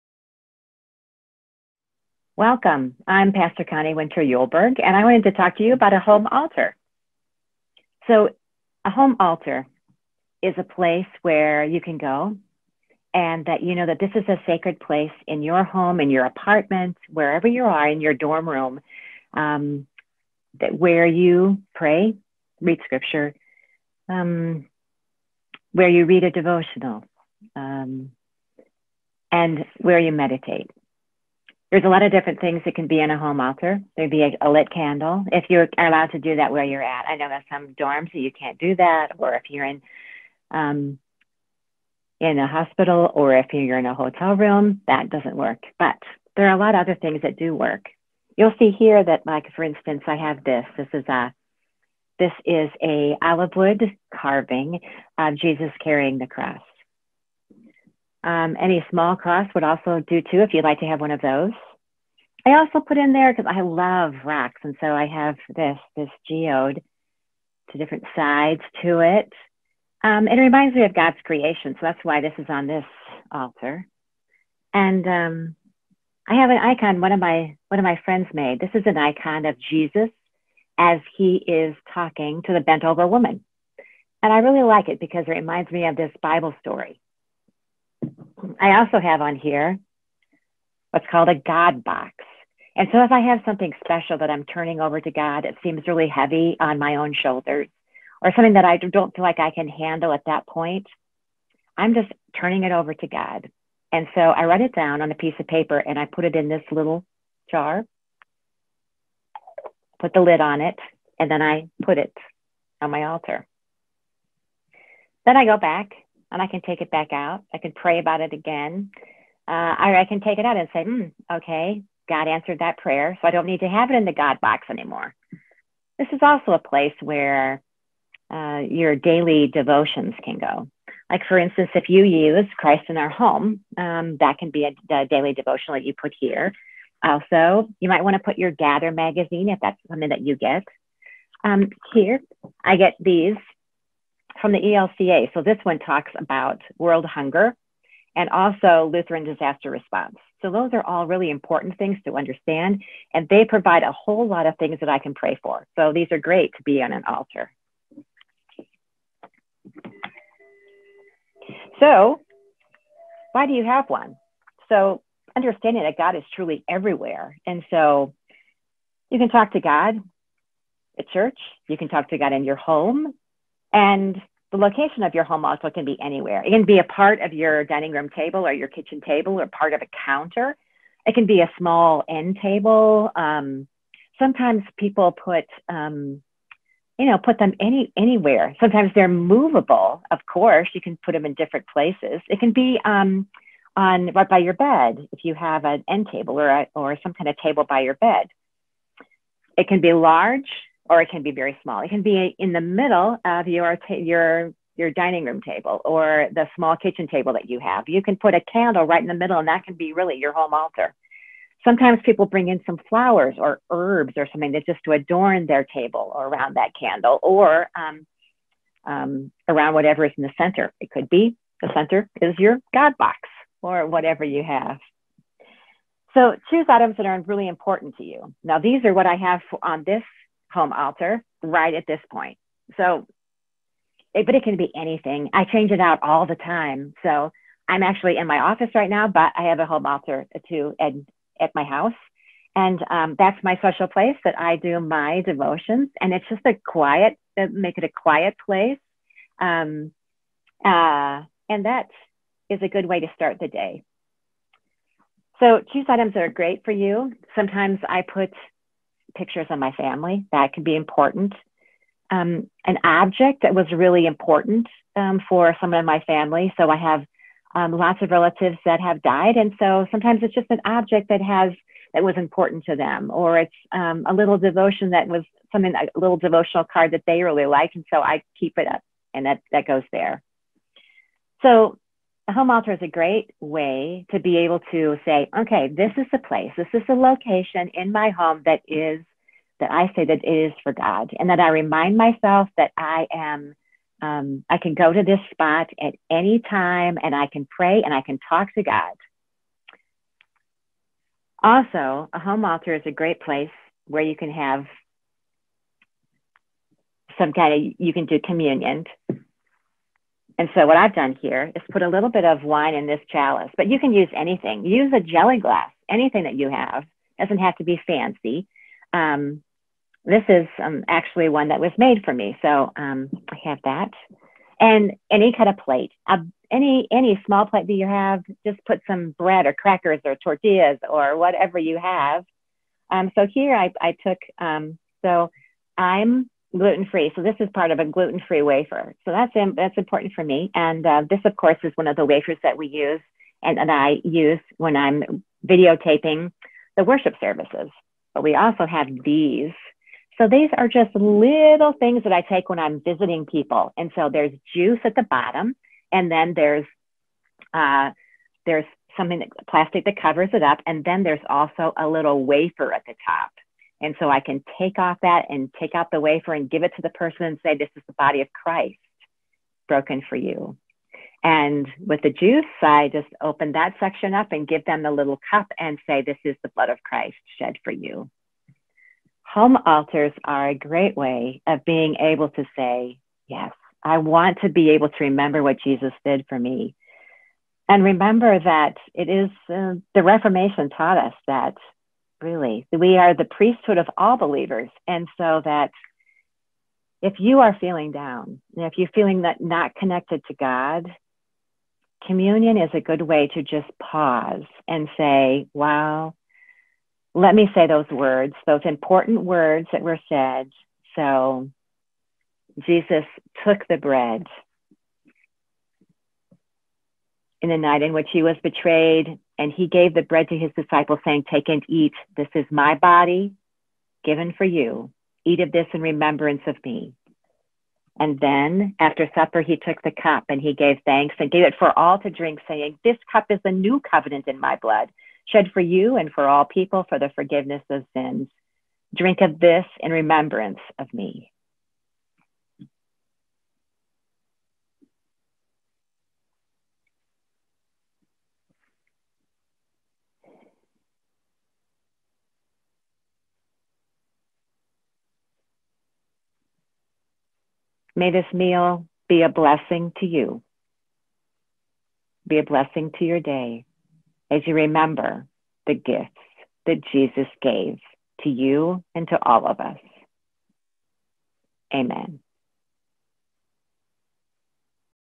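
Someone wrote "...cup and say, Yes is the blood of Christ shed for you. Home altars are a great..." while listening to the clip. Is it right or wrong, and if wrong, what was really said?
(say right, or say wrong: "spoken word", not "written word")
wrong: "This", not "Yes".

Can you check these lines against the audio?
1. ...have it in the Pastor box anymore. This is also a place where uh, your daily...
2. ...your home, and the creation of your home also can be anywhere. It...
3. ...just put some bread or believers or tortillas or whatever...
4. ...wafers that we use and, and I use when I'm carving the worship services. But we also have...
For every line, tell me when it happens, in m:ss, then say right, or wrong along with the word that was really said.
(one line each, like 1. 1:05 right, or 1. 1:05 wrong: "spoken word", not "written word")
1. 2:03 wrong: "God", not "Pastor"
2. 2:52 wrong: "location", not "creation"
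3. 5:28 wrong: "crackers", not "believers"
4. 5:42 wrong: "videotaping", not "carving".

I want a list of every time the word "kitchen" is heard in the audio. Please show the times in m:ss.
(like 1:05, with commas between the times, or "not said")
2:58, 3:26.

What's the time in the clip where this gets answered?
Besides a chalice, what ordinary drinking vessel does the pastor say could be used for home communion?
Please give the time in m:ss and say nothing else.
5:14.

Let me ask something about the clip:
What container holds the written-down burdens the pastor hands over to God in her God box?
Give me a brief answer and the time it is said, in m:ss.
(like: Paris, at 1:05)
little jar, at 1:46.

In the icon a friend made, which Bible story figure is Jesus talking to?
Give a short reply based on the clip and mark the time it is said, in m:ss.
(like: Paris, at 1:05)
the bent over woman, at 1:22.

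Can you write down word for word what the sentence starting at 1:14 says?
And um, I have an icon one of my one of my friends made.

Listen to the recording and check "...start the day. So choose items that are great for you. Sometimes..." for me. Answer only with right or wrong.
right.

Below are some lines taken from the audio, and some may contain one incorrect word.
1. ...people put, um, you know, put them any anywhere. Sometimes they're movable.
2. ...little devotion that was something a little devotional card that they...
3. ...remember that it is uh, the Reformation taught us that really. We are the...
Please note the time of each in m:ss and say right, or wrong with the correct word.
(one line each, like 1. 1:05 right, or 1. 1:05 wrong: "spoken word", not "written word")
1. 3:04 right
2. 4:34 right
3. 6:27 right.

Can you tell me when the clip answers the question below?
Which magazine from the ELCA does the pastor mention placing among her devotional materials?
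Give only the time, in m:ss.
2:18.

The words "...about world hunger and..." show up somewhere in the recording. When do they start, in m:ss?
2:26.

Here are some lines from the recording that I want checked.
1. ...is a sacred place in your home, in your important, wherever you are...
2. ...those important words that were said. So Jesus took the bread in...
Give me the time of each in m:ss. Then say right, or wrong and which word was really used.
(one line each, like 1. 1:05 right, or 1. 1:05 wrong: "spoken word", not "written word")
1. 0:14 wrong: "apartment", not "important"
2. 6:48 right.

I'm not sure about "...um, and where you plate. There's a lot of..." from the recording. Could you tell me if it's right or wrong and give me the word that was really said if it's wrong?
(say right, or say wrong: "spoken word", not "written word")
wrong: "meditate", not "plate".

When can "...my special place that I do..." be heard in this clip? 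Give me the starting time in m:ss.
4:03.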